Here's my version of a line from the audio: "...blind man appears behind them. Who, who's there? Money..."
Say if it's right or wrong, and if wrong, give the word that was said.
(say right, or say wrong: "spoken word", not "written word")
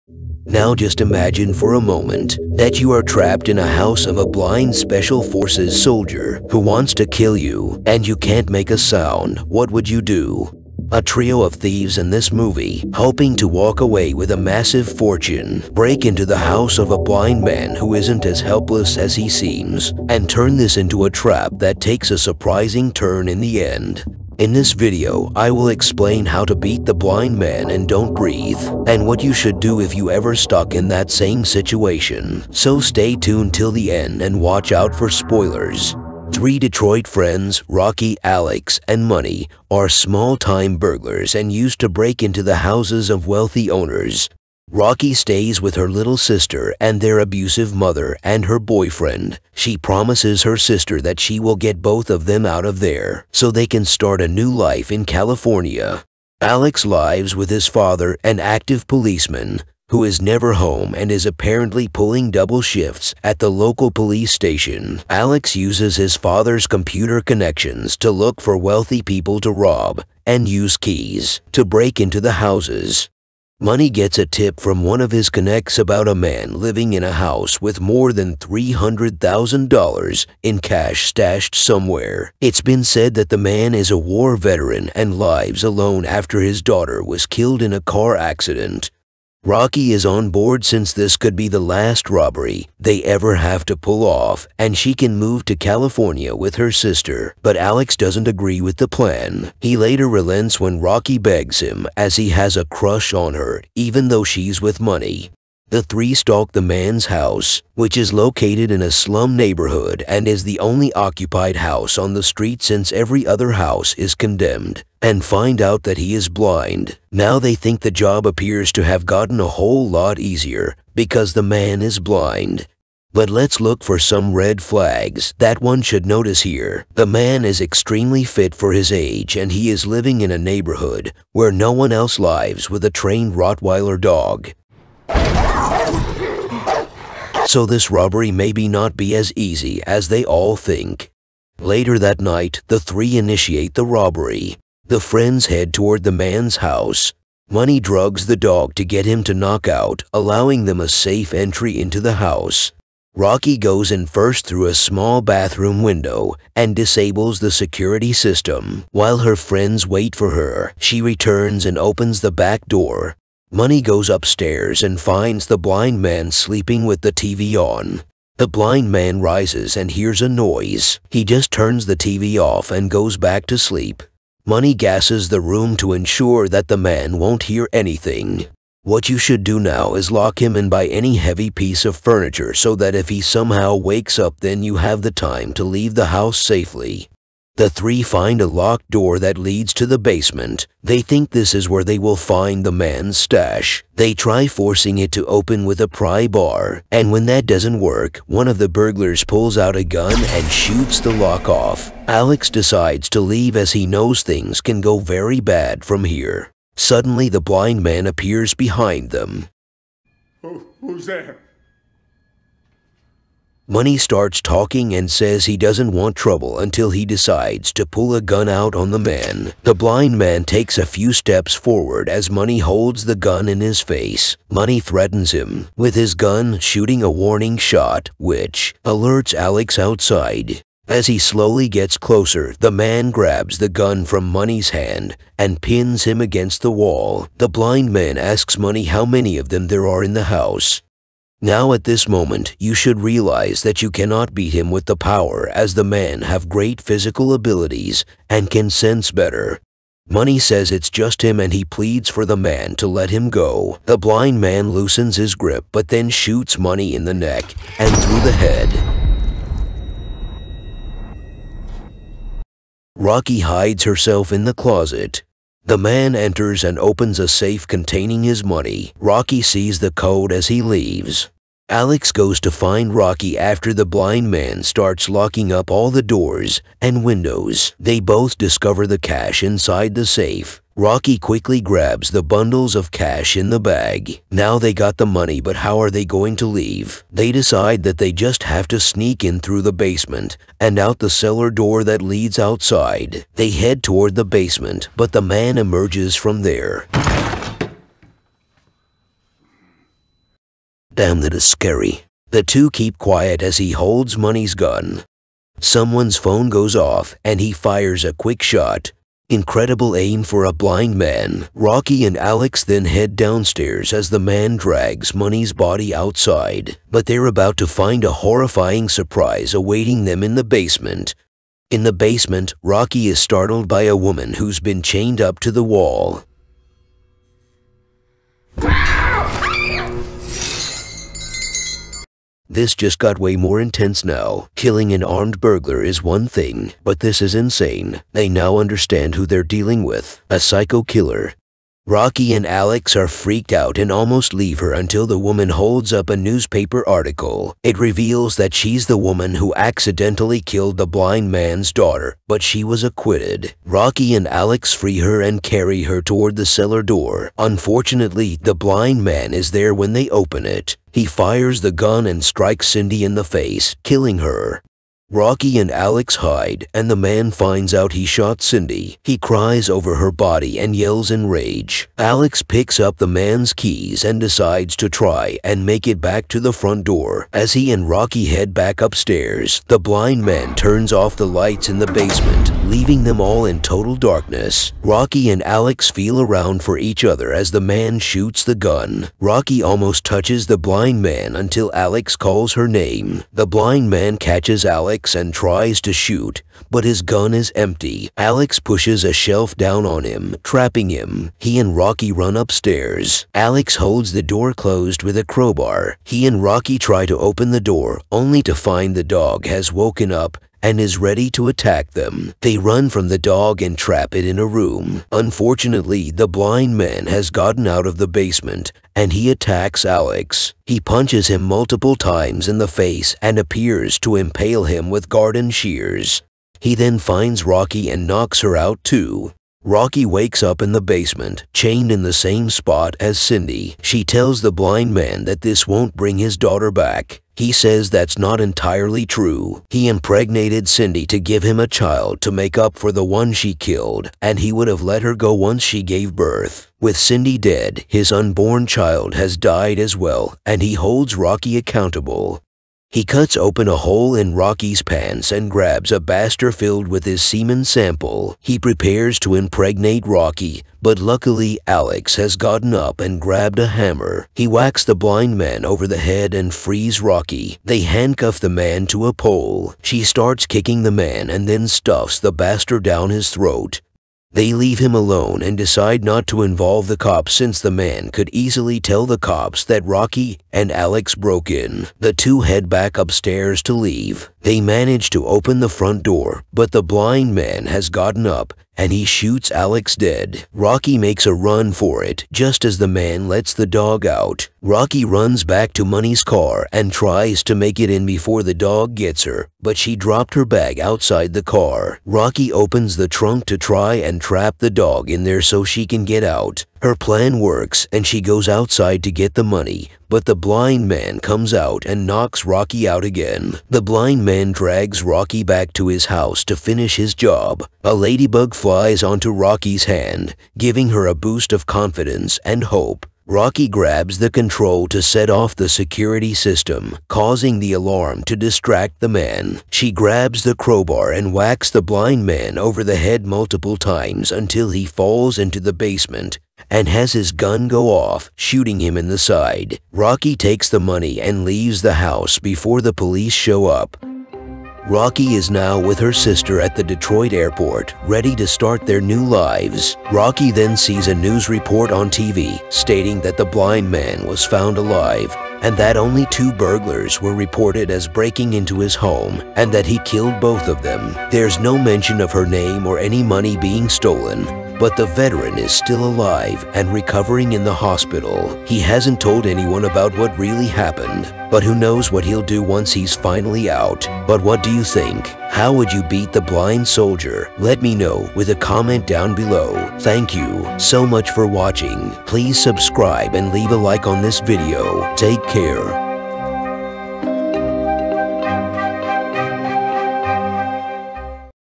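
right.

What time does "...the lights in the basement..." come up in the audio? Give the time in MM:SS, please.
06:21.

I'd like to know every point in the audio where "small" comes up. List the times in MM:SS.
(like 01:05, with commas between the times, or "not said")
00:39, 02:34.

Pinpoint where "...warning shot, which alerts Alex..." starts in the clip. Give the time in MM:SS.
03:47.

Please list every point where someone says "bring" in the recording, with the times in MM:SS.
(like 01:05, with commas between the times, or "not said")
07:15.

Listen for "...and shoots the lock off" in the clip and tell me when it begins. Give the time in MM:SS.
03:20.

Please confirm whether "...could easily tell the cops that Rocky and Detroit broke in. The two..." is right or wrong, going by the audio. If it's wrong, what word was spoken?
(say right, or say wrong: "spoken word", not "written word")
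wrong: "Alex", not "Detroit".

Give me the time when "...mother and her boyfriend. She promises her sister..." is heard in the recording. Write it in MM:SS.
00:47.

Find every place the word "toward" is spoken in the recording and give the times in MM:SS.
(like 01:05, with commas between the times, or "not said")
02:25, 04:53, 05:56.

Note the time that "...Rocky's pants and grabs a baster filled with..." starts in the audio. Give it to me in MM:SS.
07:34.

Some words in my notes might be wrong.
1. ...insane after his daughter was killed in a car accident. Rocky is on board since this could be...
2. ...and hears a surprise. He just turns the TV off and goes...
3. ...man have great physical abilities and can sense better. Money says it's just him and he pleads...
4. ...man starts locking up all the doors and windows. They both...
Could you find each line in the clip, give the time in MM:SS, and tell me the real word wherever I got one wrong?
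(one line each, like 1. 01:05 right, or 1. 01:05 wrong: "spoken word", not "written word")
1. 01:25 wrong: "alone", not "insane"
2. 02:49 wrong: "noise", not "surprise"
3. 04:05 right
4. 04:34 right.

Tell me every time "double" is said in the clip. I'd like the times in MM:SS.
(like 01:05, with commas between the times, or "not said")
01:02.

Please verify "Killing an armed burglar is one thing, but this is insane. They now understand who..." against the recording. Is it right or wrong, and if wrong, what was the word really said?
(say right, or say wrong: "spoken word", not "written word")
right.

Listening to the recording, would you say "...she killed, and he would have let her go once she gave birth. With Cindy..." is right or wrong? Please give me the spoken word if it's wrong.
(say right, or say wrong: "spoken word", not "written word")
right.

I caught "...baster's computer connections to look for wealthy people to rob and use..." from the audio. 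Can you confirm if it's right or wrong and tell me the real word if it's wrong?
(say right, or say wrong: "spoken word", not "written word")
wrong: "father", not "baster".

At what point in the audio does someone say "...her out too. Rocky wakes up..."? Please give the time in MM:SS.
07:08.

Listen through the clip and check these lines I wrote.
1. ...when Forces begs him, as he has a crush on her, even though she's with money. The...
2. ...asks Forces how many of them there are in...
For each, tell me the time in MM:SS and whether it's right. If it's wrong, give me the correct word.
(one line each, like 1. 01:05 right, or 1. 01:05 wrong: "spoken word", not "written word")
1. 01:40 wrong: "Rocky", not "Forces"
2. 03:58 wrong: "Money", not "Forces".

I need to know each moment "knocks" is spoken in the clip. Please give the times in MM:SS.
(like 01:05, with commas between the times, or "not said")
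02:29, 07:08, 08:32.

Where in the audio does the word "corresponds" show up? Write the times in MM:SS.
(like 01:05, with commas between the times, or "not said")
not said.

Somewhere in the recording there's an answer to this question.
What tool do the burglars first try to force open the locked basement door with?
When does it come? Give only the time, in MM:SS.
03:15.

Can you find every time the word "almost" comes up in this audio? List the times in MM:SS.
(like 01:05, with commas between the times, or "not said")
05:43, 06:29.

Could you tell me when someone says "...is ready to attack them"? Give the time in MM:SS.
06:50.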